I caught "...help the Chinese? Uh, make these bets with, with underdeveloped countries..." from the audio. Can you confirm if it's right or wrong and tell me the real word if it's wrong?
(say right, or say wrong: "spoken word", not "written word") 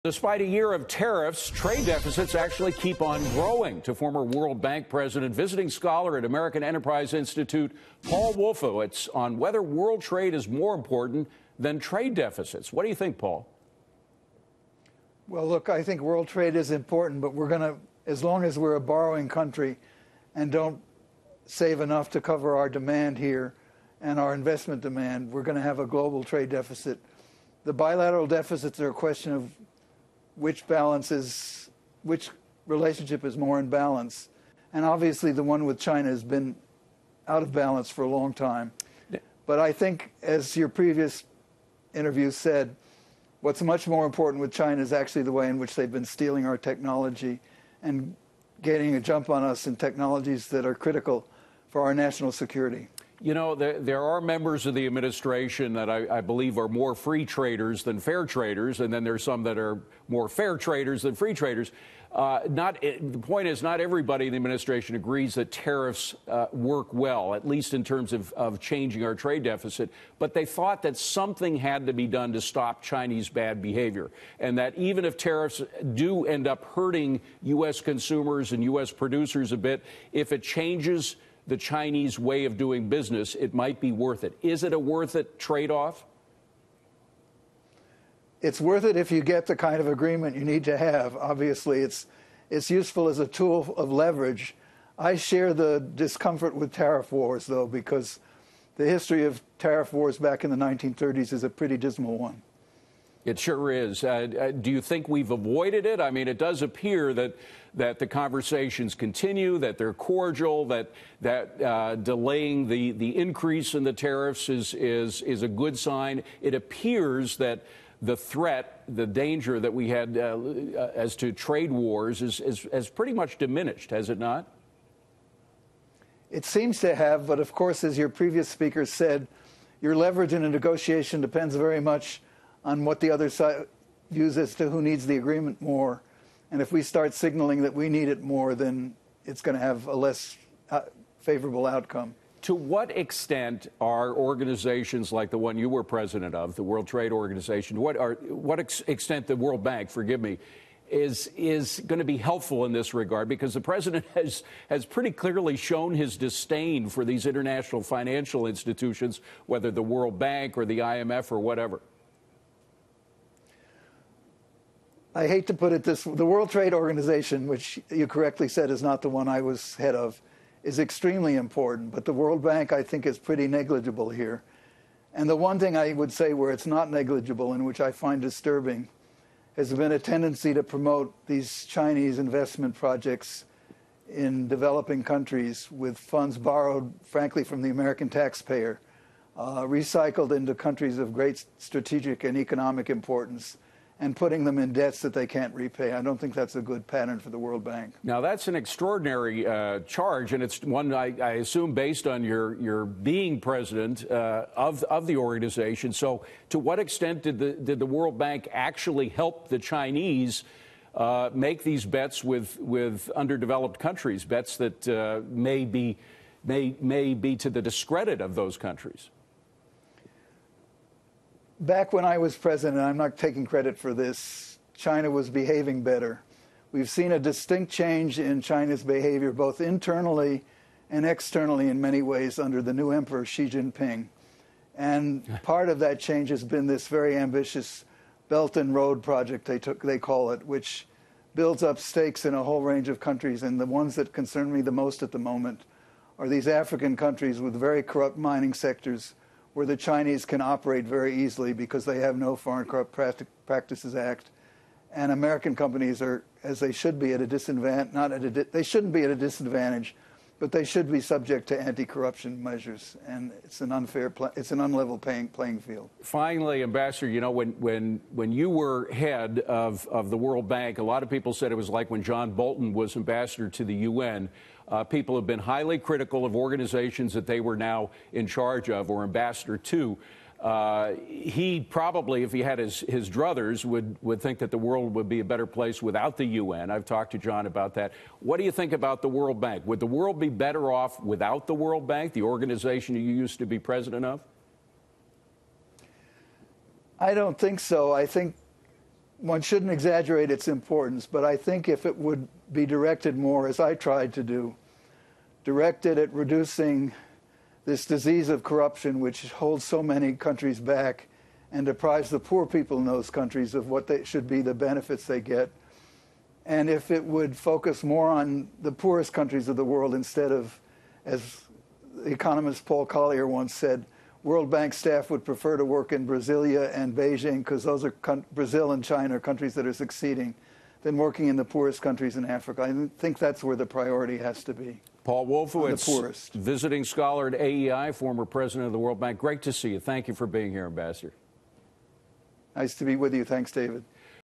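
right.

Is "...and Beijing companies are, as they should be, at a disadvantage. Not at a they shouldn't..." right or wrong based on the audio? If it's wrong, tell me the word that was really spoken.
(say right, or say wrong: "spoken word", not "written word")
wrong: "American", not "Beijing".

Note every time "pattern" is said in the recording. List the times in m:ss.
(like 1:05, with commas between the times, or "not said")
3:16.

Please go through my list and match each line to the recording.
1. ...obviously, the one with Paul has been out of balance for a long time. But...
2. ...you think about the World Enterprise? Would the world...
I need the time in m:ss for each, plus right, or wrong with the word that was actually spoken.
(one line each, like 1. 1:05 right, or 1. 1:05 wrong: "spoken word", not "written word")
1. 0:34 wrong: "China", not "Paul"
2. 4:48 wrong: "Bank", not "Enterprise".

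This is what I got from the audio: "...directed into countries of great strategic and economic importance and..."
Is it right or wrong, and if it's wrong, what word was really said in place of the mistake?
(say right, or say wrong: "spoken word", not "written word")
wrong: "recycled", not "directed".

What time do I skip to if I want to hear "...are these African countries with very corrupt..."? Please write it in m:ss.
4:06.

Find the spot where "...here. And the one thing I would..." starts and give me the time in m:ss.
2:54.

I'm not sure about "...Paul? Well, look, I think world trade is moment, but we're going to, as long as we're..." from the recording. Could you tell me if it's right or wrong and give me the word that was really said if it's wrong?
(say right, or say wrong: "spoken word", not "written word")
wrong: "important", not "moment".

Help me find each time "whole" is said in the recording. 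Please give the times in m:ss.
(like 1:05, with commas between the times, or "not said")
4:02.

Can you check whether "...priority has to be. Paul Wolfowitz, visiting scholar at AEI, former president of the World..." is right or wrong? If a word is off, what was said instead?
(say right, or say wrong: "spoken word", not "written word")
right.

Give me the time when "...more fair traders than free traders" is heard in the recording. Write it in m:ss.
1:00.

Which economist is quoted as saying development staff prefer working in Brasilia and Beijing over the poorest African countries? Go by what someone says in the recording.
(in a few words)
Paul Collier.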